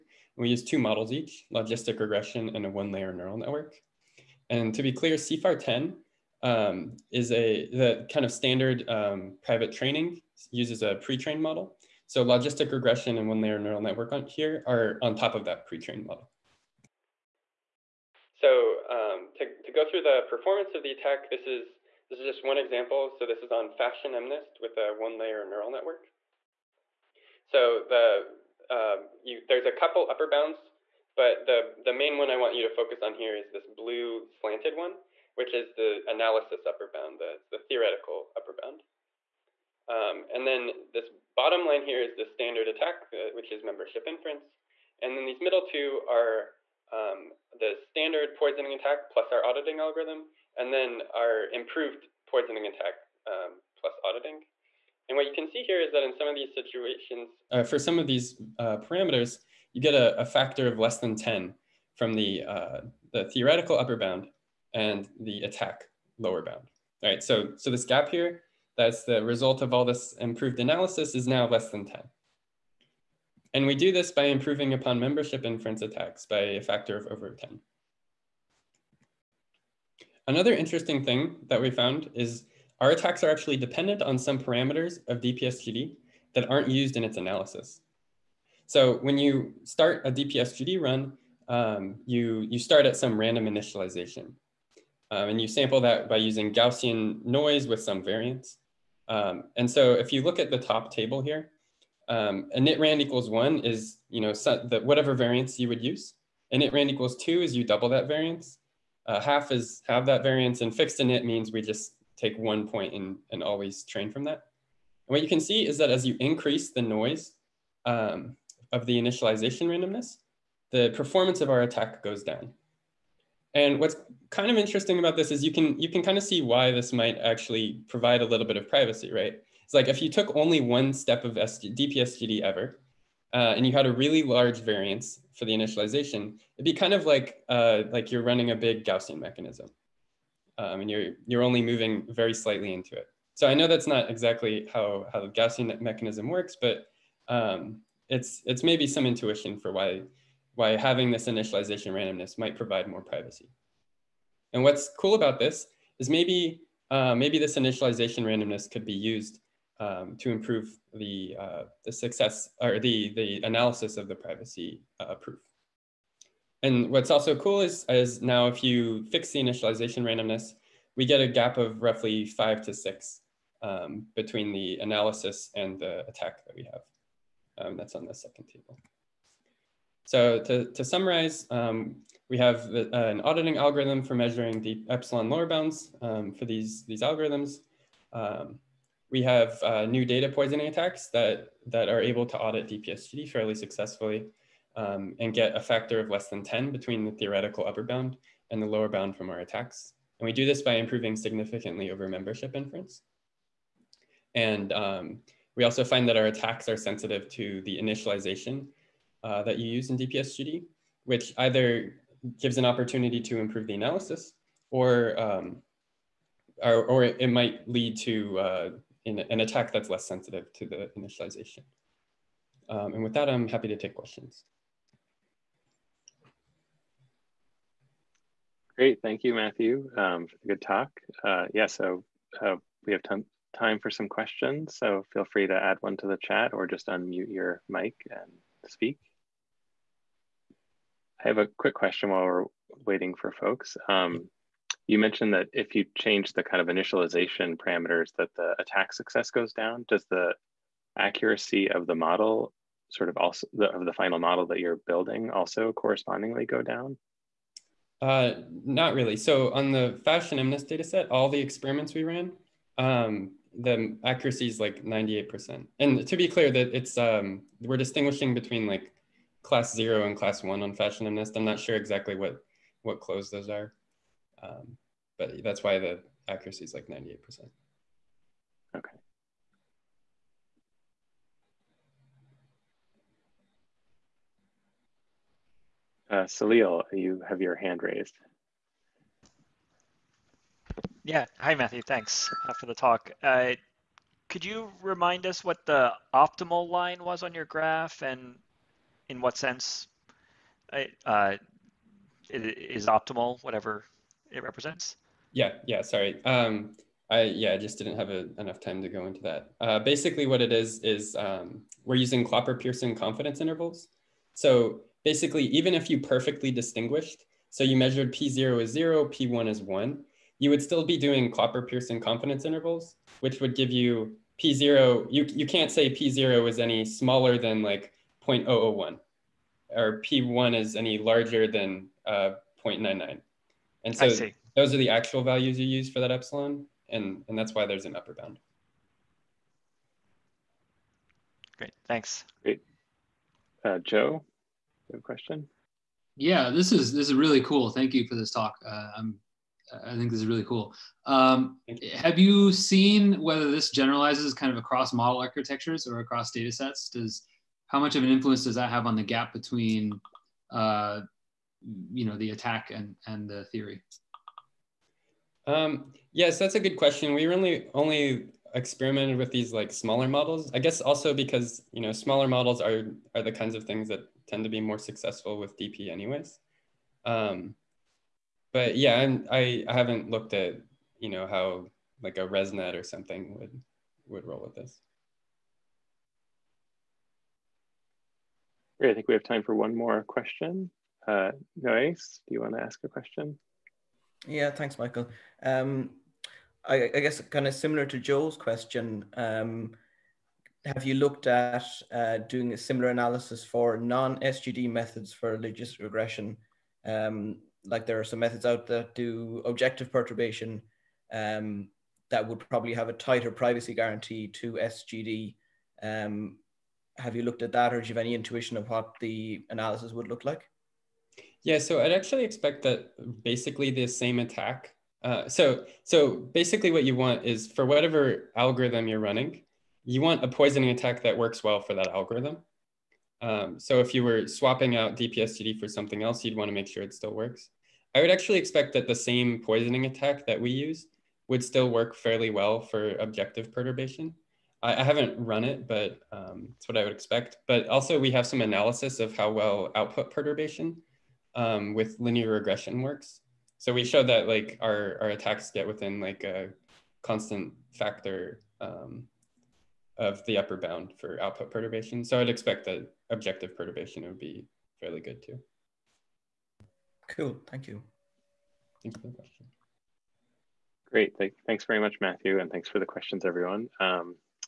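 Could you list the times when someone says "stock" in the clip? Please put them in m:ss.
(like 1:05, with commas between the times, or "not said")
not said.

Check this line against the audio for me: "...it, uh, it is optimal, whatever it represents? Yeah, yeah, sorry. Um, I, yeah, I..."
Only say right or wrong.
right.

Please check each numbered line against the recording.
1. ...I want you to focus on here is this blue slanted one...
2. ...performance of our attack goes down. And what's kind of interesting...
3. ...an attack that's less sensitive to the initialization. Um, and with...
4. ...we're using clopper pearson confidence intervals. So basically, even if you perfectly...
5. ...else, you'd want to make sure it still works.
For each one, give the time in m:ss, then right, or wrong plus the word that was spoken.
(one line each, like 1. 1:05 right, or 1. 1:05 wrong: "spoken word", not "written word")
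1. 0:32 right
2. 2:00 right
3. 3:39 right
4. 5:11 right
5. 7:16 right.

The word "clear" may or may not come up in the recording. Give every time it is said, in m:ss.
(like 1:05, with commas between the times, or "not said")
0:04, 4:26.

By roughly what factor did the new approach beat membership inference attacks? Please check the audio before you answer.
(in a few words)
over 10.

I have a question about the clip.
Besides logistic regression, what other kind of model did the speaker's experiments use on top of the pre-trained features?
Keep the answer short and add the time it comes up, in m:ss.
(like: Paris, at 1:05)
one-layer neural network, at 0:02.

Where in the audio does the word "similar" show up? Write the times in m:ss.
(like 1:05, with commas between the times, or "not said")
6:37, 6:42.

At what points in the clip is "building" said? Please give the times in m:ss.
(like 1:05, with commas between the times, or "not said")
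4:14.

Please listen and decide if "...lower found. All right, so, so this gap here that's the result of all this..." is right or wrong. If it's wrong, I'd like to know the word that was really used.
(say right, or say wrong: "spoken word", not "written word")
wrong: "bound", not "found".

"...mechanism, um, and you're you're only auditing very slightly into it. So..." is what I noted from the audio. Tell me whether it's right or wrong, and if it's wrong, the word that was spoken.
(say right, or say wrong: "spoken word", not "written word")
wrong: "moving", not "auditing".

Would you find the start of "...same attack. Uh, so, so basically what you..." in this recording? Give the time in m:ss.
7:03.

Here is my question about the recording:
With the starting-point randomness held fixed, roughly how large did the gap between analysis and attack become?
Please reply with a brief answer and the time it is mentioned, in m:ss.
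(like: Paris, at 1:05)
5 to 6, at 2:52.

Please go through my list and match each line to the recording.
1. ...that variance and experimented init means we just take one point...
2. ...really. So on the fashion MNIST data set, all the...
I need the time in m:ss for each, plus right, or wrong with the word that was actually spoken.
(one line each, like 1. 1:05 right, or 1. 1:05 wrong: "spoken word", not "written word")
1. 1:50 wrong: "fixed", not "experimented"
2. 4:18 right.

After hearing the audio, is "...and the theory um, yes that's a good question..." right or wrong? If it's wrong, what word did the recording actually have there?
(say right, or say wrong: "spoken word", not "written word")
right.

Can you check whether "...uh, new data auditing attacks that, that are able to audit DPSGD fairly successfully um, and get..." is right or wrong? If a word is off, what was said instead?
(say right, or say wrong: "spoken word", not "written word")
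wrong: "poisoning", not "auditing".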